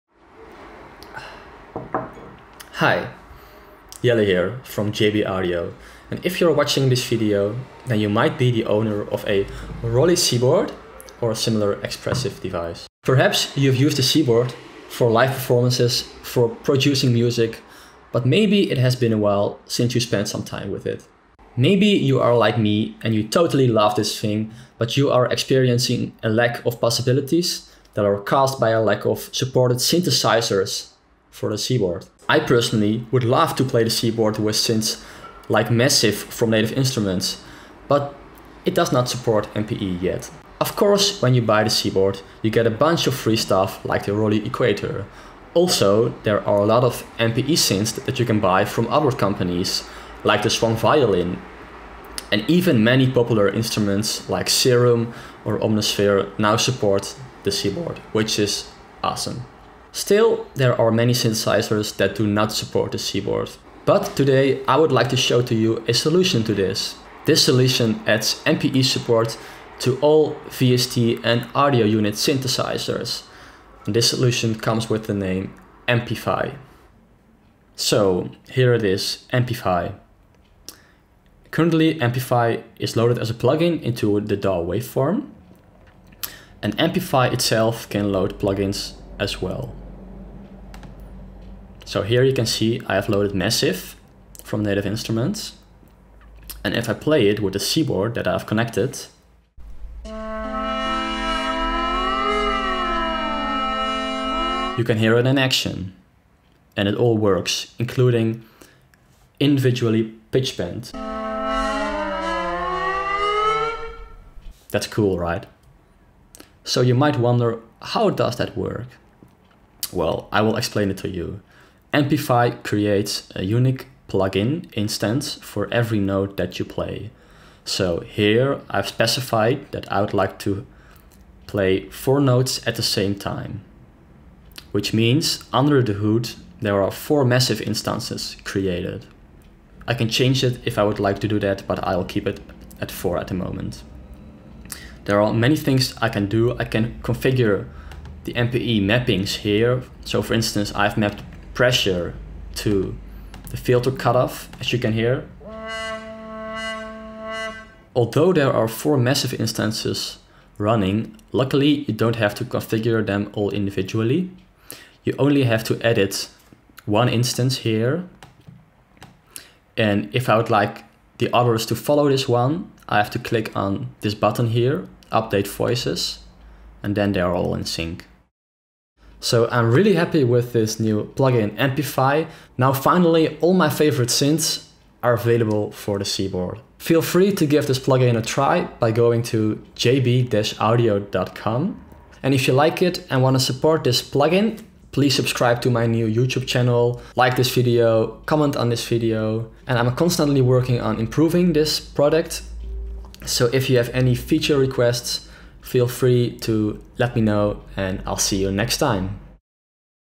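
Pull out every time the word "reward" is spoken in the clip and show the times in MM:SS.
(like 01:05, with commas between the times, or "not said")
not said.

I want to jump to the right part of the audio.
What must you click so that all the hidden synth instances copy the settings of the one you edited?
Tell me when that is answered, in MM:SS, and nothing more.
02:55.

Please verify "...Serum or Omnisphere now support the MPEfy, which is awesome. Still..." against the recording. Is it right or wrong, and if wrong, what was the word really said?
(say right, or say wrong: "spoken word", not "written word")
wrong: "Seaboard", not "MPEfy".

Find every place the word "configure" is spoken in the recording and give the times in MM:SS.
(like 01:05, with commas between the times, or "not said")
02:27, 02:42.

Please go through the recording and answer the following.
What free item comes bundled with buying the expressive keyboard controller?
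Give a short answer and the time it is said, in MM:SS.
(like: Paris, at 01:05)
ROLI Equator, at 00:44.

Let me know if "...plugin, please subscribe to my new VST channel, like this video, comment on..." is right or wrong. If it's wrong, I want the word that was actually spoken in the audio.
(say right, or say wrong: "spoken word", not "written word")
wrong: "YouTube", not "VST".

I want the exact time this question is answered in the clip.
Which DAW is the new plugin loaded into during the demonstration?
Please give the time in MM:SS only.
01:24.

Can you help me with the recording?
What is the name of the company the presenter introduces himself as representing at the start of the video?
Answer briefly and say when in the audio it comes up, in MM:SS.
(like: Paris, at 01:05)
JB Audio, at 00:04.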